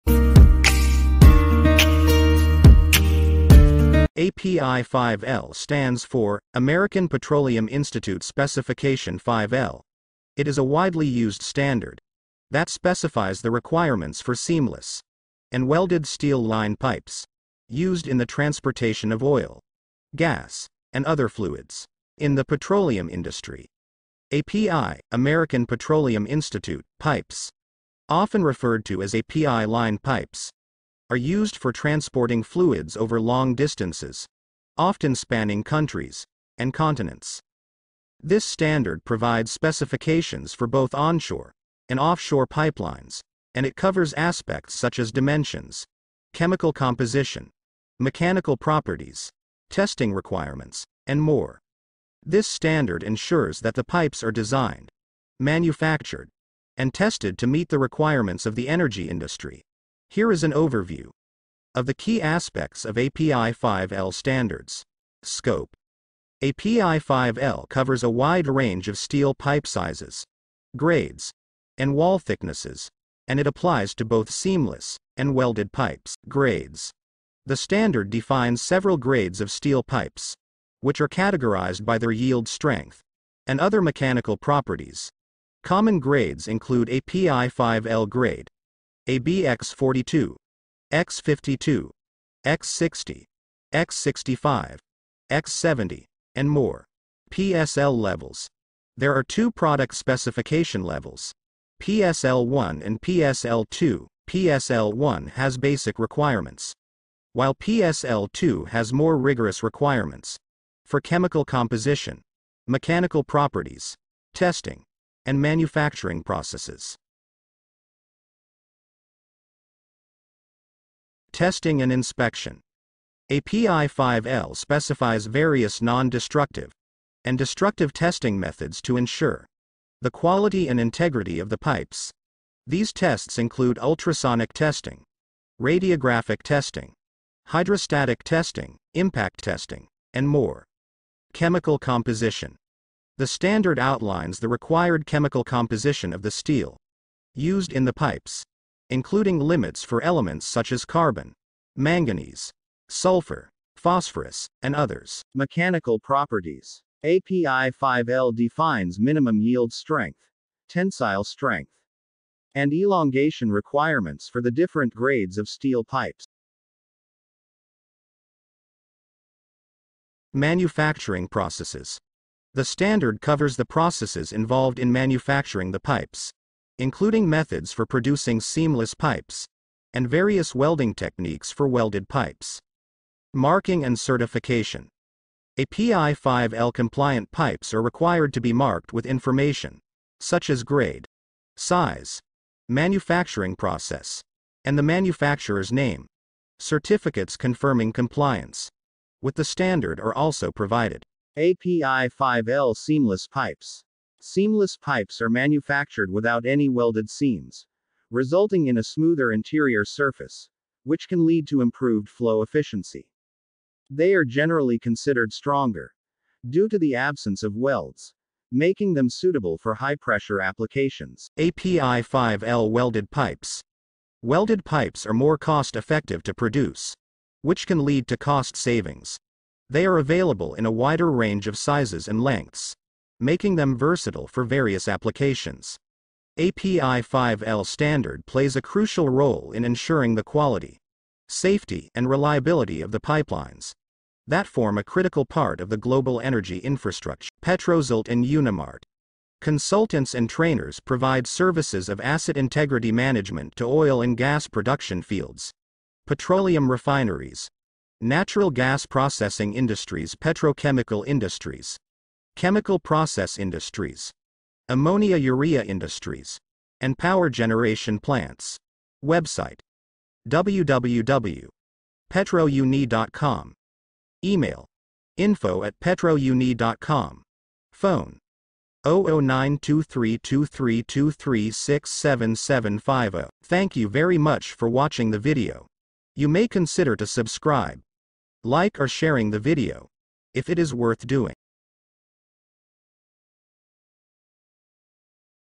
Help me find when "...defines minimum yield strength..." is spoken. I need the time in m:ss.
2:38.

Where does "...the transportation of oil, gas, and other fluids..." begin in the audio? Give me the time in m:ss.
0:18.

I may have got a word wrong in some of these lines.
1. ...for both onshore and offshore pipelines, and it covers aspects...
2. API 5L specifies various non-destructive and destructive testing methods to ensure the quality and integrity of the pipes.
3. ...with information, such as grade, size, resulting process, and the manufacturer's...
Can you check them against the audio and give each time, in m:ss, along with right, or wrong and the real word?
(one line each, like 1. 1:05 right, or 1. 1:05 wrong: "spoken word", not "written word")
1. 0:40 right
2. 2:03 right
3. 3:08 wrong: "manufacturing", not "resulting".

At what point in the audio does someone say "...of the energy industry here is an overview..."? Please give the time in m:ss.
0:58.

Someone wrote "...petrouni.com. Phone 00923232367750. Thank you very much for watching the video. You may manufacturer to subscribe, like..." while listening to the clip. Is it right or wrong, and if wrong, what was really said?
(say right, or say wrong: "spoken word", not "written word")
wrong: "consider", not "manufacturer".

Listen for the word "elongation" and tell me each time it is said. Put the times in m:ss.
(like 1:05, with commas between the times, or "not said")
2:42.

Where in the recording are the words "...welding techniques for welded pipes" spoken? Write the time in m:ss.
3:00.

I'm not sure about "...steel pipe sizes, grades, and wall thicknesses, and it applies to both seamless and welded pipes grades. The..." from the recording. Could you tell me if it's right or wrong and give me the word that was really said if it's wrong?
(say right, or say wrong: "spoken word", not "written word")
right.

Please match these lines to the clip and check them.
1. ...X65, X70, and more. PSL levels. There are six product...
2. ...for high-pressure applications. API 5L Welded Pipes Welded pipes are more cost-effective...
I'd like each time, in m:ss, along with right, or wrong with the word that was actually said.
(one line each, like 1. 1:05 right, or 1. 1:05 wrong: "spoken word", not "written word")
1. 1:33 wrong: "two", not "six"
2. 3:39 right.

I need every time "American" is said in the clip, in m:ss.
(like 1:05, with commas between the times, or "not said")
0:06, 0:25.